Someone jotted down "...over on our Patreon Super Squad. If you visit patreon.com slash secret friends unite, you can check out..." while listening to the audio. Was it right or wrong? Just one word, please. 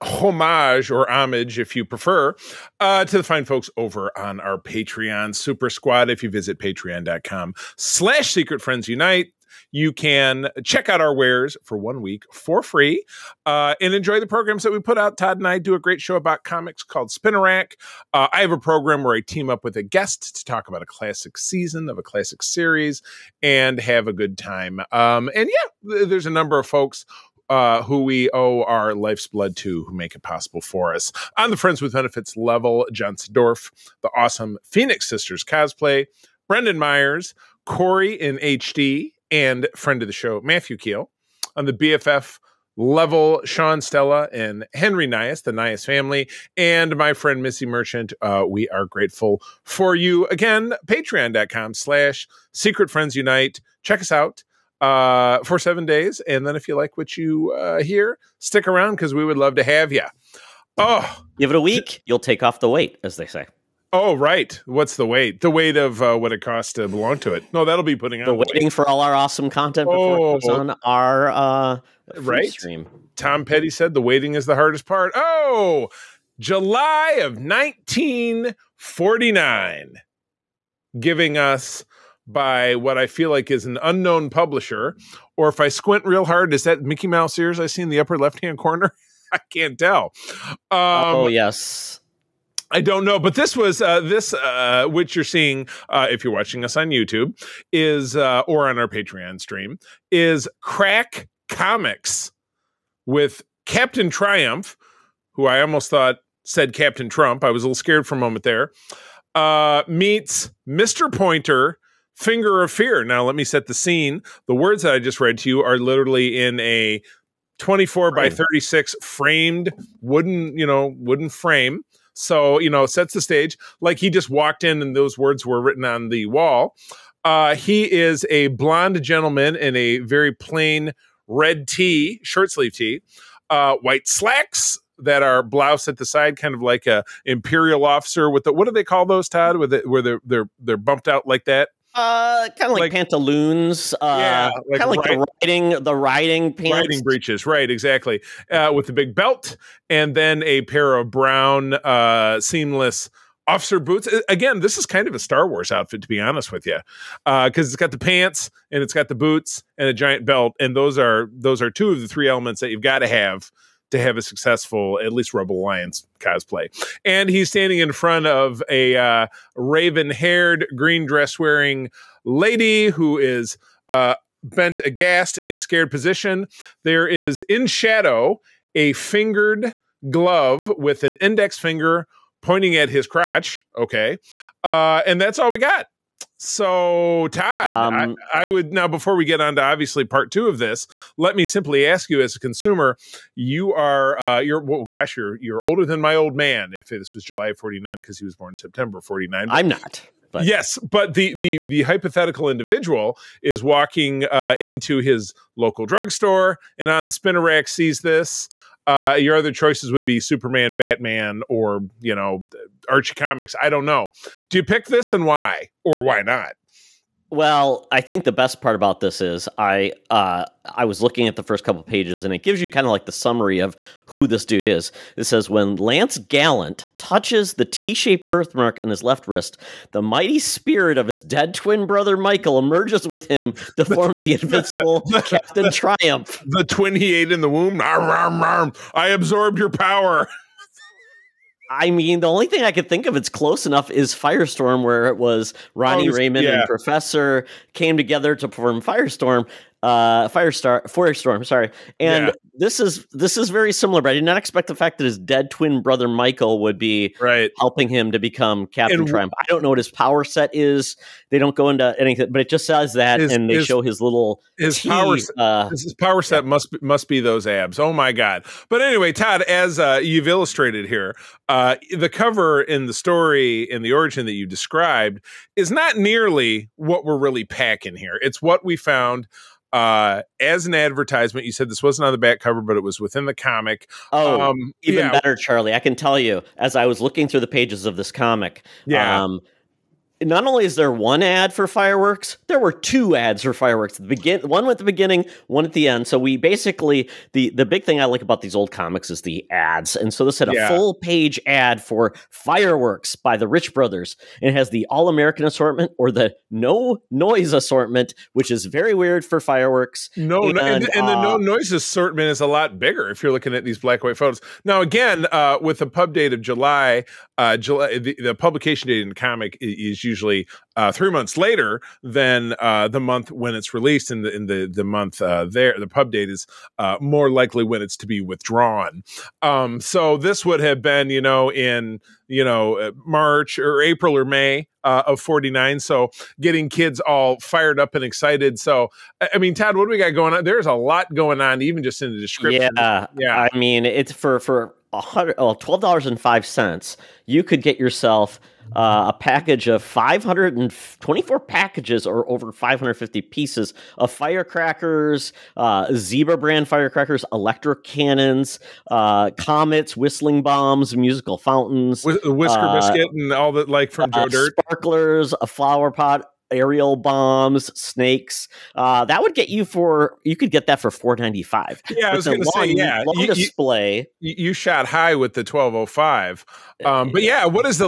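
right.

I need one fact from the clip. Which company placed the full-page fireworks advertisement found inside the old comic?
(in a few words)
Rich Brothers.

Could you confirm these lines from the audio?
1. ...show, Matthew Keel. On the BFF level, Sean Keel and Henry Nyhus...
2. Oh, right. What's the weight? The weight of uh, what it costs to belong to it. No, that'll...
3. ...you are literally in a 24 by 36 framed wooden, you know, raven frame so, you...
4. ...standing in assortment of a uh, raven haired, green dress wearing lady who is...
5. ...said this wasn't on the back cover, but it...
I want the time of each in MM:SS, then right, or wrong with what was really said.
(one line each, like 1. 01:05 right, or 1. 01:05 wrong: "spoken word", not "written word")
1. 00:40 wrong: "Stella", not "Keel"
2. 01:03 right
3. 01:55 wrong: "wooden", not "raven"
4. 02:47 wrong: "front", not "assortment"
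5. 04:41 right.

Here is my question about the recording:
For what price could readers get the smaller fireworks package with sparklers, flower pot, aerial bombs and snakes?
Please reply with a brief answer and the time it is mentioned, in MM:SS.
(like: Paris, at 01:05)
$4.95, at 06:10.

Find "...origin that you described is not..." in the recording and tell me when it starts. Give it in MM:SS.
04:33.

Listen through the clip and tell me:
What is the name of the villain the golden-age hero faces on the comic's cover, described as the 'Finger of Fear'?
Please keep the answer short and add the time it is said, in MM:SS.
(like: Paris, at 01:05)
Mr. Pointer, at 01:50.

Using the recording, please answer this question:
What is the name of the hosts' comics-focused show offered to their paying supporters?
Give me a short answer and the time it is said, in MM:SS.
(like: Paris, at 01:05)
Spinnerack, at 00:17.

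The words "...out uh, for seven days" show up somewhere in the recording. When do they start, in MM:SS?
00:54.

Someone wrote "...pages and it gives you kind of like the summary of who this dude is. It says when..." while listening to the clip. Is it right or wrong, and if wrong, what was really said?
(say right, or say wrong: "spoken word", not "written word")
right.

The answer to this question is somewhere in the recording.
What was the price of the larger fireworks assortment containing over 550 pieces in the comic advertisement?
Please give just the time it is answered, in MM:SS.
05:44.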